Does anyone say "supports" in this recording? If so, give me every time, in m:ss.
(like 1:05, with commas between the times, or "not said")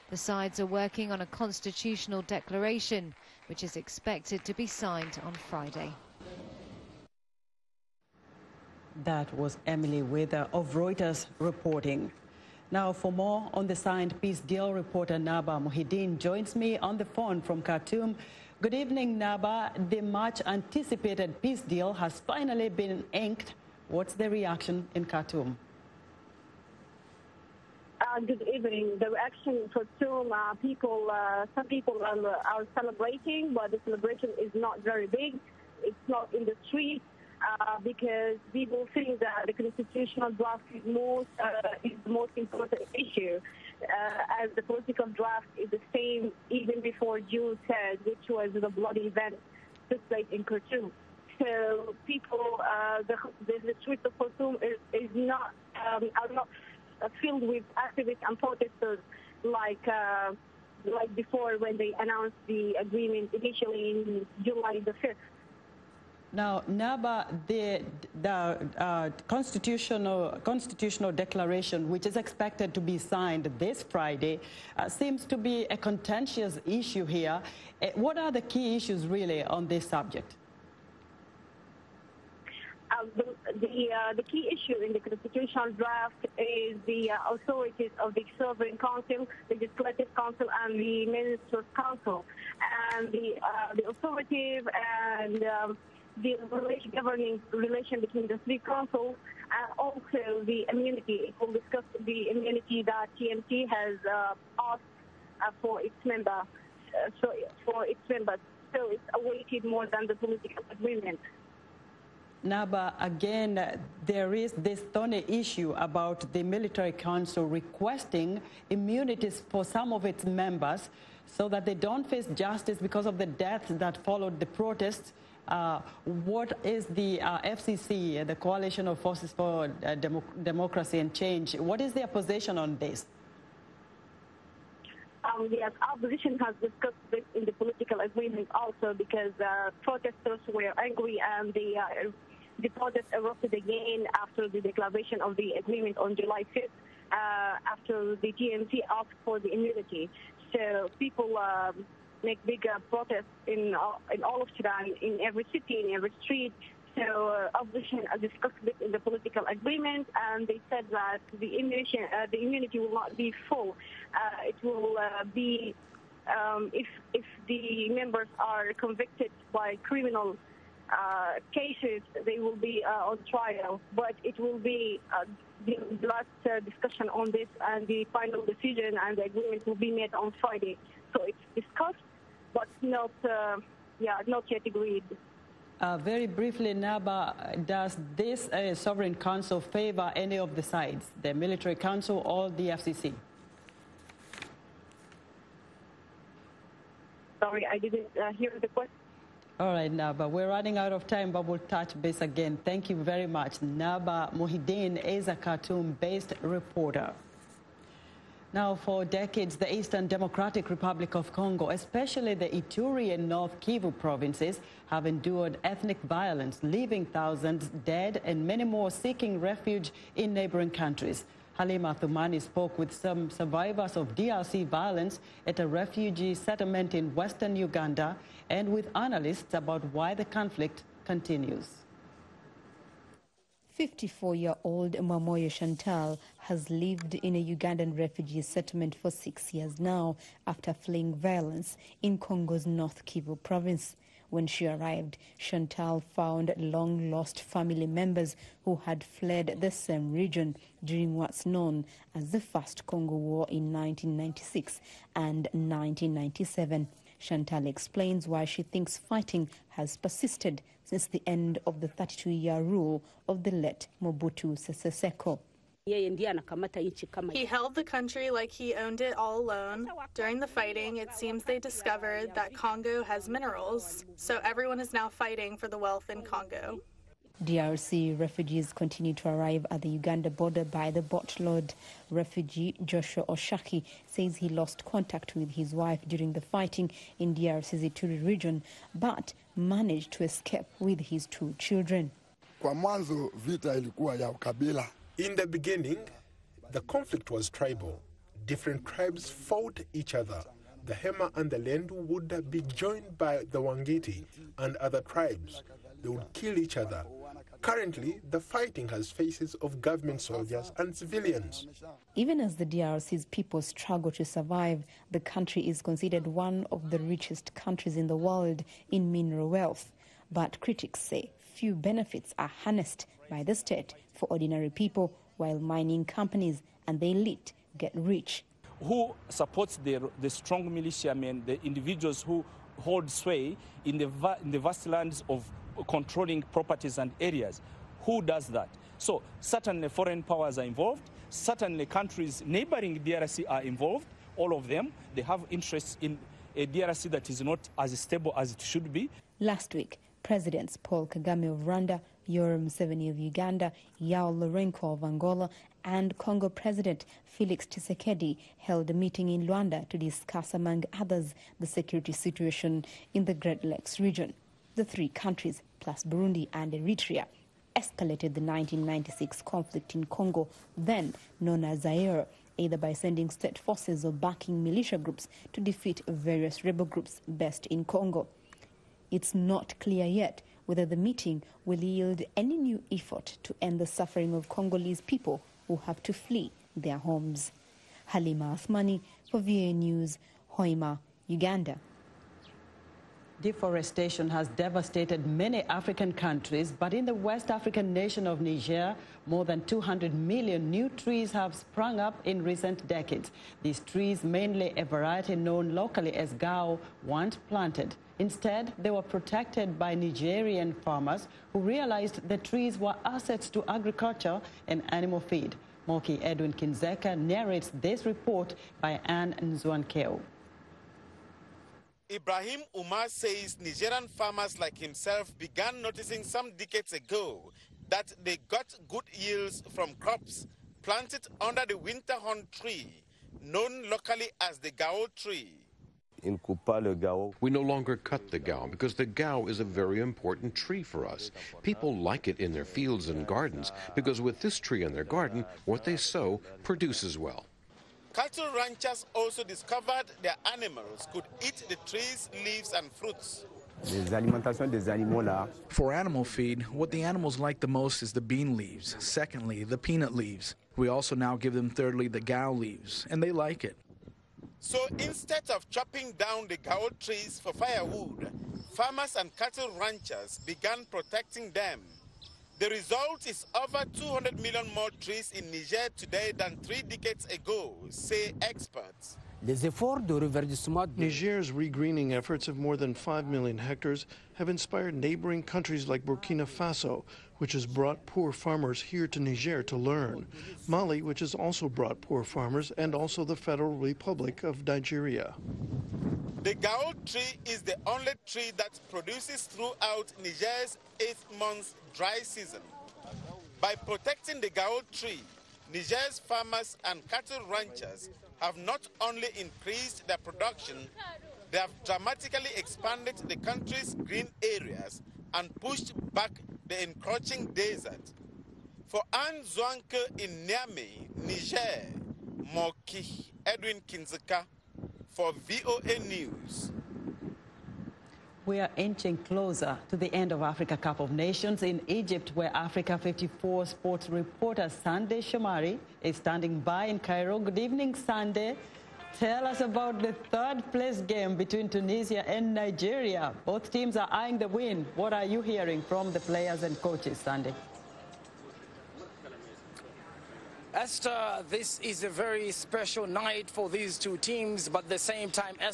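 5:29.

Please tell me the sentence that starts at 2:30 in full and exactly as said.
So people um, make big uh, protests in all, uh, in all of Sudan, in every city, in every street.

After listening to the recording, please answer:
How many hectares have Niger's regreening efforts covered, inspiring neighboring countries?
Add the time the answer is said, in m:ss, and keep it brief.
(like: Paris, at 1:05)
more than 5 million, at 8:02.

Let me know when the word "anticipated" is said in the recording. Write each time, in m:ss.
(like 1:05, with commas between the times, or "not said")
0:20.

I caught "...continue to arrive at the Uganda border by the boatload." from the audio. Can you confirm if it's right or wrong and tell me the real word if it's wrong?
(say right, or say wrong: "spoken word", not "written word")
right.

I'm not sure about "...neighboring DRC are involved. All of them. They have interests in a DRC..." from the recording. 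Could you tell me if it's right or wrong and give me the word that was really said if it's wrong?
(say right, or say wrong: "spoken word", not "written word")
right.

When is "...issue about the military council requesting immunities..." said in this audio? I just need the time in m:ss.
1:55.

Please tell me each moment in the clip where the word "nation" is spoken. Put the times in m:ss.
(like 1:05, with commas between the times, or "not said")
6:37, 8:51.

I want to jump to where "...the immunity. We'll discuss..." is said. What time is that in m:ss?
1:40.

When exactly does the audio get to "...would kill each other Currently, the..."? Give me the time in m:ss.
5:06.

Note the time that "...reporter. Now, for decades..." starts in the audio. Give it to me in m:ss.
3:26.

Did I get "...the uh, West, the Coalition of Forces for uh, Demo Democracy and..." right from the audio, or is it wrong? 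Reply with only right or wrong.
wrong.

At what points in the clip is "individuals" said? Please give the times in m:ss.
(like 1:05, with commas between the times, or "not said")
5:31.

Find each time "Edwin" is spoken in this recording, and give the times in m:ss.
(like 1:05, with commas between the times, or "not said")
6:56, 8:43.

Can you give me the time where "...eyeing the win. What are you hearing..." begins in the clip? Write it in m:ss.
9:04.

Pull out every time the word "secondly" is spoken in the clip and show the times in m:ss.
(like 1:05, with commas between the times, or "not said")
7:38.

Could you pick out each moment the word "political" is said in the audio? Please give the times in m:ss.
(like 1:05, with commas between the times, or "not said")
0:44, 1:50, 2:17, 2:38.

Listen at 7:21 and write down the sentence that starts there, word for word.
People like it in their fields and gardens because with this tree in their garden, what they sow produces well.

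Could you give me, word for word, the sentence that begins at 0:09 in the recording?
That was Emily Wither of Reuters reporting.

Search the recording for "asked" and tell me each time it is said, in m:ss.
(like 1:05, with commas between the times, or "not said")
1:44, 2:28.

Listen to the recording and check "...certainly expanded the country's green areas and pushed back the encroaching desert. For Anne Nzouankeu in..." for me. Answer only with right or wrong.
wrong.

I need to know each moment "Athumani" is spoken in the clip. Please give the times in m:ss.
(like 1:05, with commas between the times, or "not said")
3:41, 6:28.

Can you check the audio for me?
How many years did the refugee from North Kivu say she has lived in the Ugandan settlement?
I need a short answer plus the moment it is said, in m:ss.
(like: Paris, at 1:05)
6 years, at 3:59.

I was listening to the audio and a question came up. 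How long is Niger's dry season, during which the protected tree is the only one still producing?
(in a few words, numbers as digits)
8 months.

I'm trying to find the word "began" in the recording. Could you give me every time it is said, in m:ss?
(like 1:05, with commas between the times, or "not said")
7:05, 7:50.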